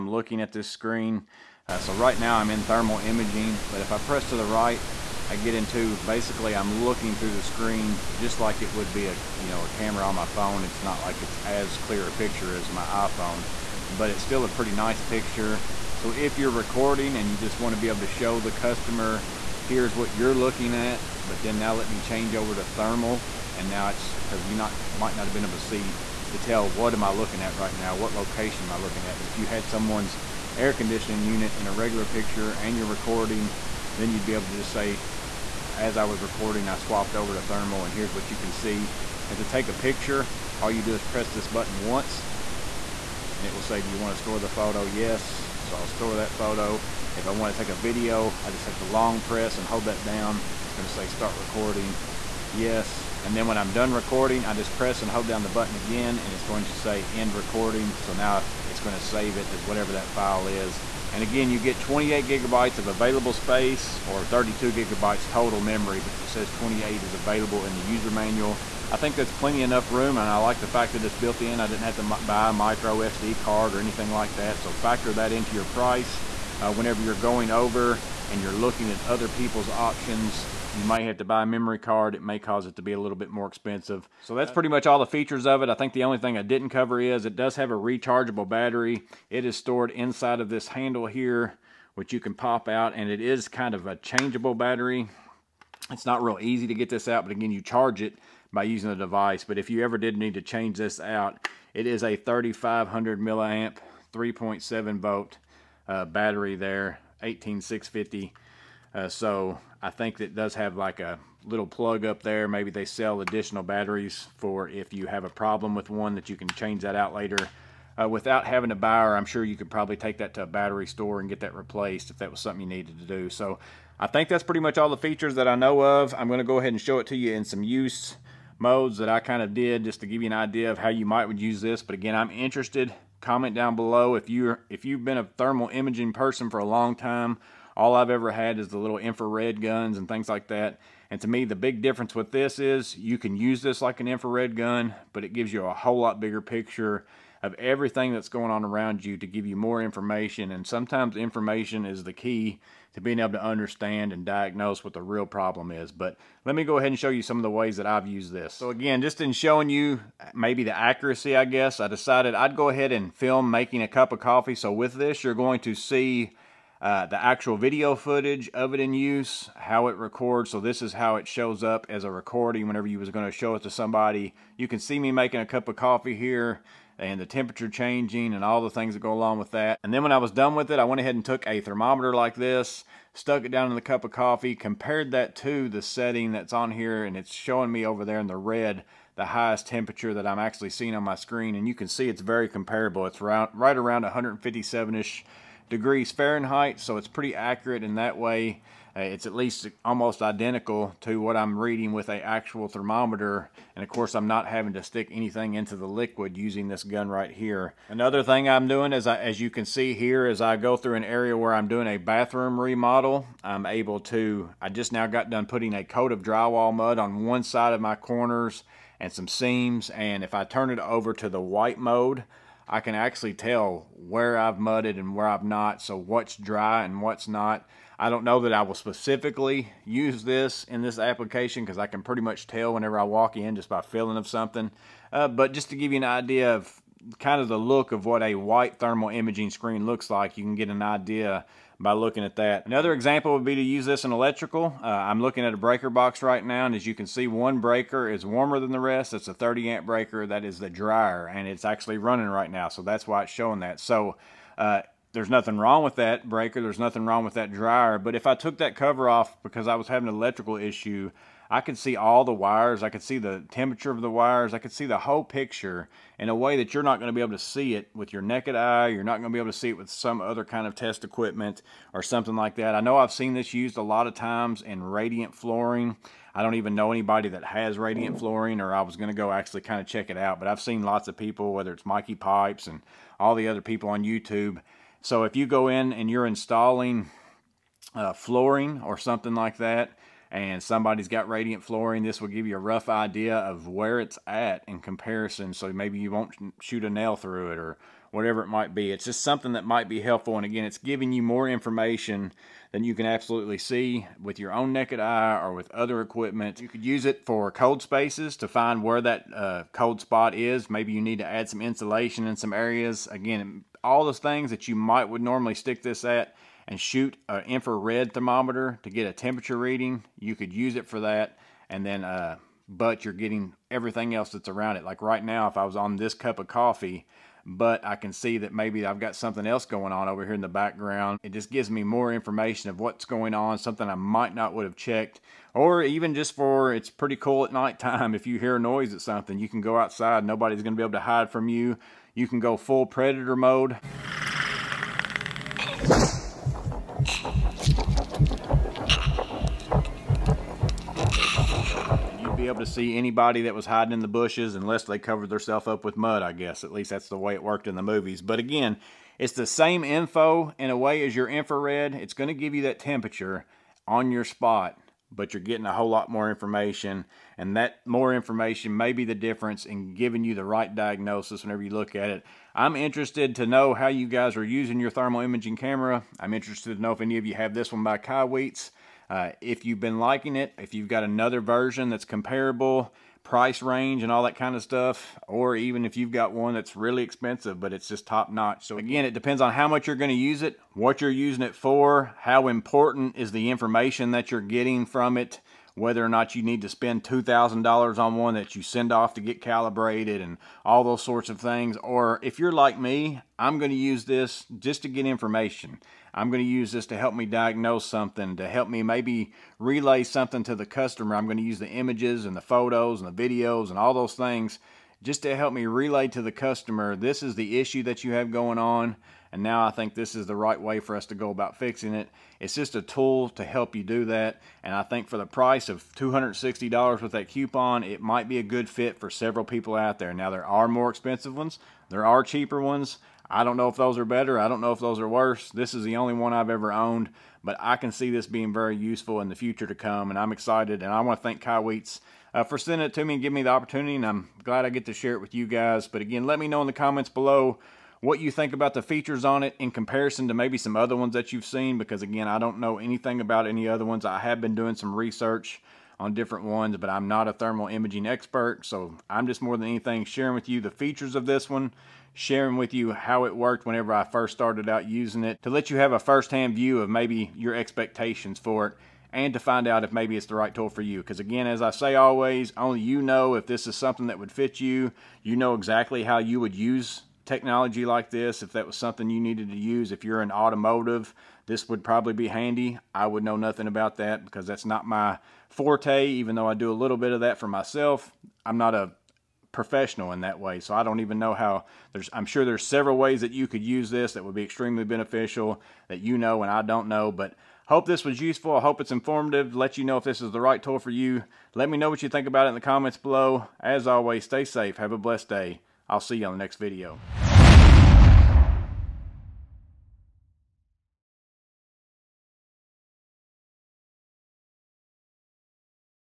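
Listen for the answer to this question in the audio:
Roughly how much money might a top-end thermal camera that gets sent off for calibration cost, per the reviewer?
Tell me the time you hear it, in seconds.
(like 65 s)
397 s.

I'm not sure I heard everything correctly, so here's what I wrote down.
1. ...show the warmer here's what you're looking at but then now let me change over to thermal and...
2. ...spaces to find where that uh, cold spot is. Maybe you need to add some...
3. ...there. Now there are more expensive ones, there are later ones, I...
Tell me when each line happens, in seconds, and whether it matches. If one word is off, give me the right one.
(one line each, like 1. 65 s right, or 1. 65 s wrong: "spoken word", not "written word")
1. 18 s wrong: "customer", not "warmer"
2. 307 s right
3. 429 s wrong: "cheaper", not "later".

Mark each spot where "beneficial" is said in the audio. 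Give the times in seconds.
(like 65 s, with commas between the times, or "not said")
494 s.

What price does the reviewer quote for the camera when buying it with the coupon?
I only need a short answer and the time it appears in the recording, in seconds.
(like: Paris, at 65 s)
$260, at 425 s.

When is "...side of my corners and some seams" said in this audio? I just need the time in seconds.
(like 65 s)
217 s.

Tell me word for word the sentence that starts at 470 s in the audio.
Because again, as I say always, only you know if this is something that would fit you.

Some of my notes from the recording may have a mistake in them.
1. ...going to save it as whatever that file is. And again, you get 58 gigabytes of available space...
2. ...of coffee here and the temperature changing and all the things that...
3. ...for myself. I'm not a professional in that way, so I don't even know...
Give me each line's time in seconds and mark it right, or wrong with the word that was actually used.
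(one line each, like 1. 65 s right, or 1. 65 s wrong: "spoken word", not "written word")
1. 58 s wrong: "28", not "58"
2. 175 s right
3. 487 s right.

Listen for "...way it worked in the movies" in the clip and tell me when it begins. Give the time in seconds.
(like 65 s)
357 s.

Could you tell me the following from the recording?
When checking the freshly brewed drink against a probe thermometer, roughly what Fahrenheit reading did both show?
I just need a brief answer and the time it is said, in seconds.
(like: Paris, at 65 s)
157, at 194 s.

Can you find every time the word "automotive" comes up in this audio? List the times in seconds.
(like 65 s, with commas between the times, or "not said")
480 s.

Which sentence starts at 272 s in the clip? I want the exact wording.
I know I've seen this used a lot of times in radiant flooring.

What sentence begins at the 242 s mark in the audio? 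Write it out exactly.
Another example would be to use this in electrical.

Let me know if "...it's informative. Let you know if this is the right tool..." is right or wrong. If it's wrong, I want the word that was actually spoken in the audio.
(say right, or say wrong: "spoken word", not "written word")
right.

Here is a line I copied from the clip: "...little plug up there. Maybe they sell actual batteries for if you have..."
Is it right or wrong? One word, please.
wrong.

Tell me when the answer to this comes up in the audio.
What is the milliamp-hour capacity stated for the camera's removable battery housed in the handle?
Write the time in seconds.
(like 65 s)
102 s.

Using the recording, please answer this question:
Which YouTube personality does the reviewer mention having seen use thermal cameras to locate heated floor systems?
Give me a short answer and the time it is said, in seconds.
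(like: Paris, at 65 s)
Mikey Pipes, at 281 s.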